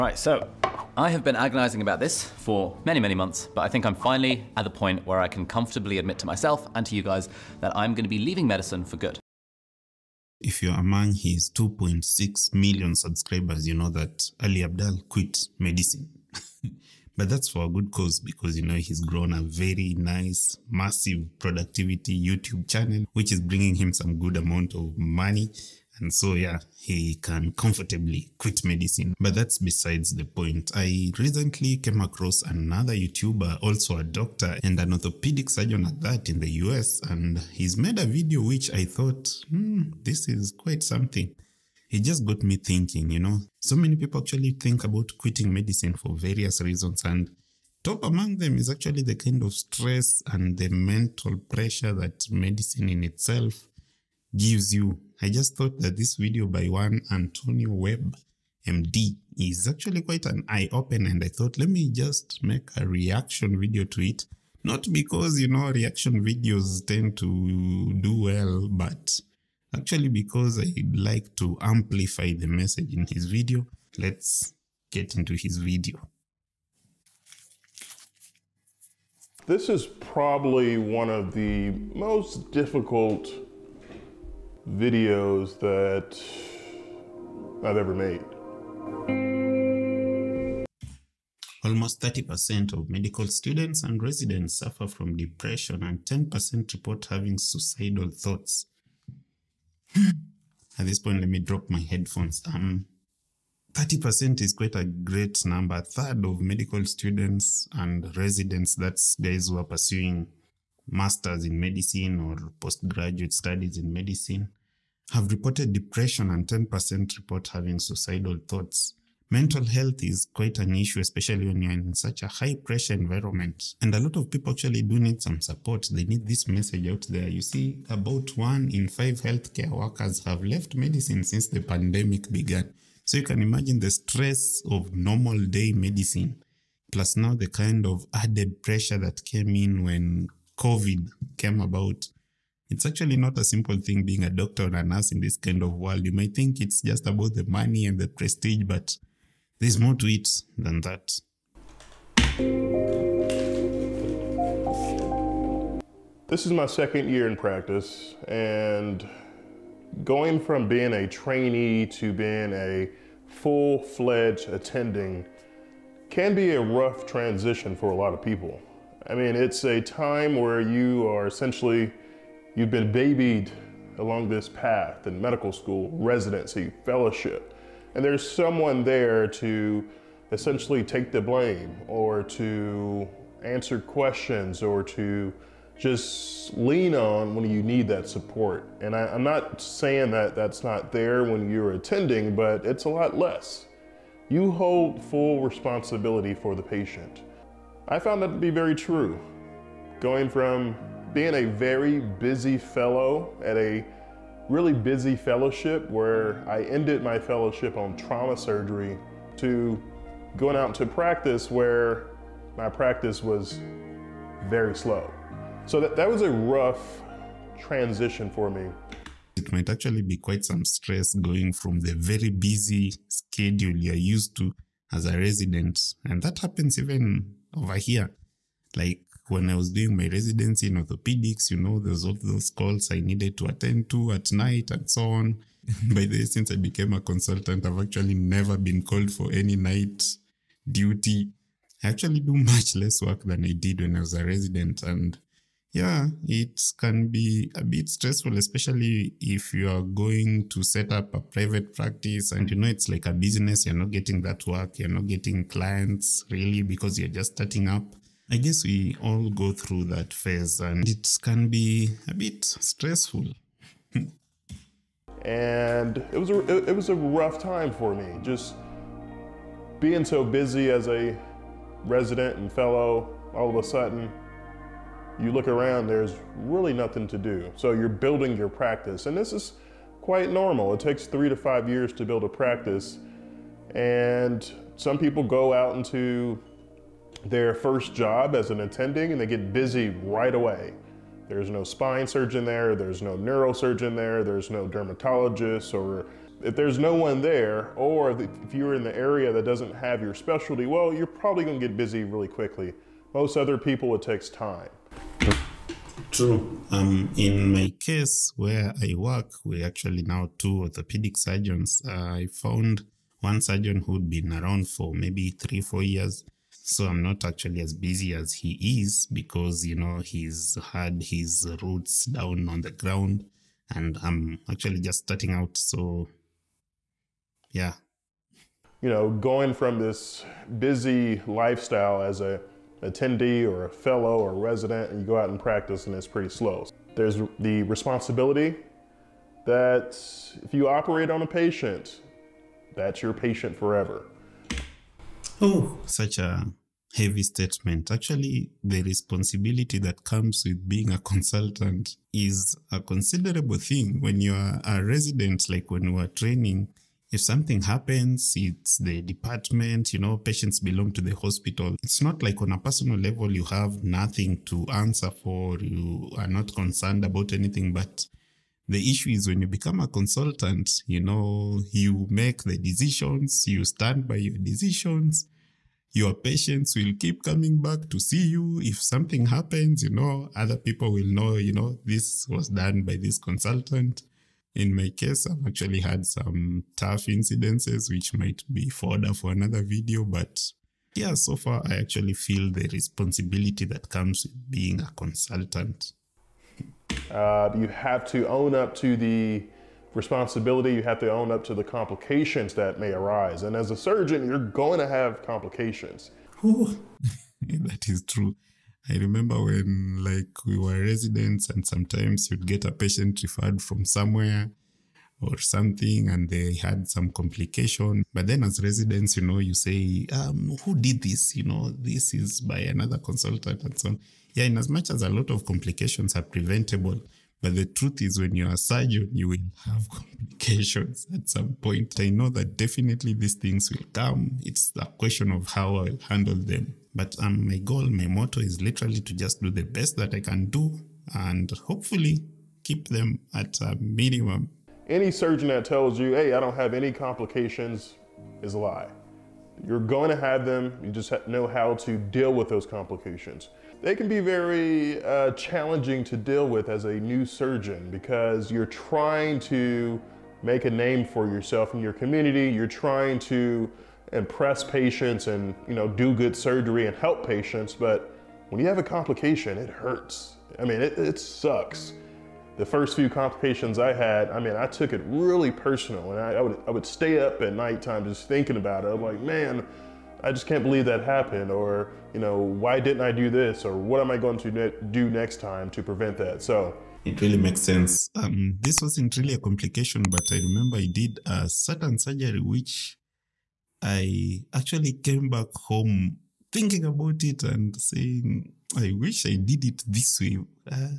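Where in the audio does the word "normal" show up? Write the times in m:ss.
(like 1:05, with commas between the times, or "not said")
2:14, 4:40.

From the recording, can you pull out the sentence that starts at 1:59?
Mental health is quite an issue, especially when you're in such a high pressure environment.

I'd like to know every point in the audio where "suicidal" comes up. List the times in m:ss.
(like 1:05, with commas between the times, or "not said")
1:37, 1:57.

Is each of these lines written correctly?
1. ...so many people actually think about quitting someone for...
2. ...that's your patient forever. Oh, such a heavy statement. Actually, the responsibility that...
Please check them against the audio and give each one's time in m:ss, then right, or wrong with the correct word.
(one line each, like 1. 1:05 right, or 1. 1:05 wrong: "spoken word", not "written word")
1. 0:43 wrong: "medicine", not "someone"
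2. 5:42 right.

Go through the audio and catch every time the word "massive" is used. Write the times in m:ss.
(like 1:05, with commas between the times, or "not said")
0:20.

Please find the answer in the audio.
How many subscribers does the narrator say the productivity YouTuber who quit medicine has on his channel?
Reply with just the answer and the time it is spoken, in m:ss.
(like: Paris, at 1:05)
2.6 million, at 0:11.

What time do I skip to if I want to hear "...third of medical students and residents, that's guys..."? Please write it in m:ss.
1:45.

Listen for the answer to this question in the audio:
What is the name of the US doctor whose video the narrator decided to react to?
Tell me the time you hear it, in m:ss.
0:57.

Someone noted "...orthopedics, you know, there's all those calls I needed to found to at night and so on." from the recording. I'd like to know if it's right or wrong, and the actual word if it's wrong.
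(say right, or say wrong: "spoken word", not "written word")
wrong: "attend", not "found".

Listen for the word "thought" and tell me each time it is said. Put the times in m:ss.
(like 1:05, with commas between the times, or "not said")
0:38, 0:55, 1:01, 1:38, 1:58.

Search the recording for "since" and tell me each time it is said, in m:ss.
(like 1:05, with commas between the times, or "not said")
2:11, 3:56.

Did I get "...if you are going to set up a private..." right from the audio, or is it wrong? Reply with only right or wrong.
right.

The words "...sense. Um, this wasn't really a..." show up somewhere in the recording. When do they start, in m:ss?
8:07.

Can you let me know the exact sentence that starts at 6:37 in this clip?
Uh, you have to own up to the responsibility, you have to own up to the complications that may arise.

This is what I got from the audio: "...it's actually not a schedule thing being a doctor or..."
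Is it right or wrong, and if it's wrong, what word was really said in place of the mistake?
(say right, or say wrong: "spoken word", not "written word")
wrong: "simple", not "schedule".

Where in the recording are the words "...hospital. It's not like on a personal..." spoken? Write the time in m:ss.
6:01.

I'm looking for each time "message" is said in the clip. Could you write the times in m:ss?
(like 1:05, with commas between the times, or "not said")
1:12, 2:06.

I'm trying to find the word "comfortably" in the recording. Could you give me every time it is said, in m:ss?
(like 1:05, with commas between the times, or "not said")
0:05, 0:27.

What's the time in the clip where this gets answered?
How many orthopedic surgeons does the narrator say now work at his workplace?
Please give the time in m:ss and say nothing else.
5:10.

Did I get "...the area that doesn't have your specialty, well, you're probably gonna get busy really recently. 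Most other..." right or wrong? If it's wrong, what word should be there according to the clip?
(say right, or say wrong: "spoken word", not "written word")
wrong: "quickly", not "recently".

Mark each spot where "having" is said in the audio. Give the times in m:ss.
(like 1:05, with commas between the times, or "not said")
1:37, 1:57.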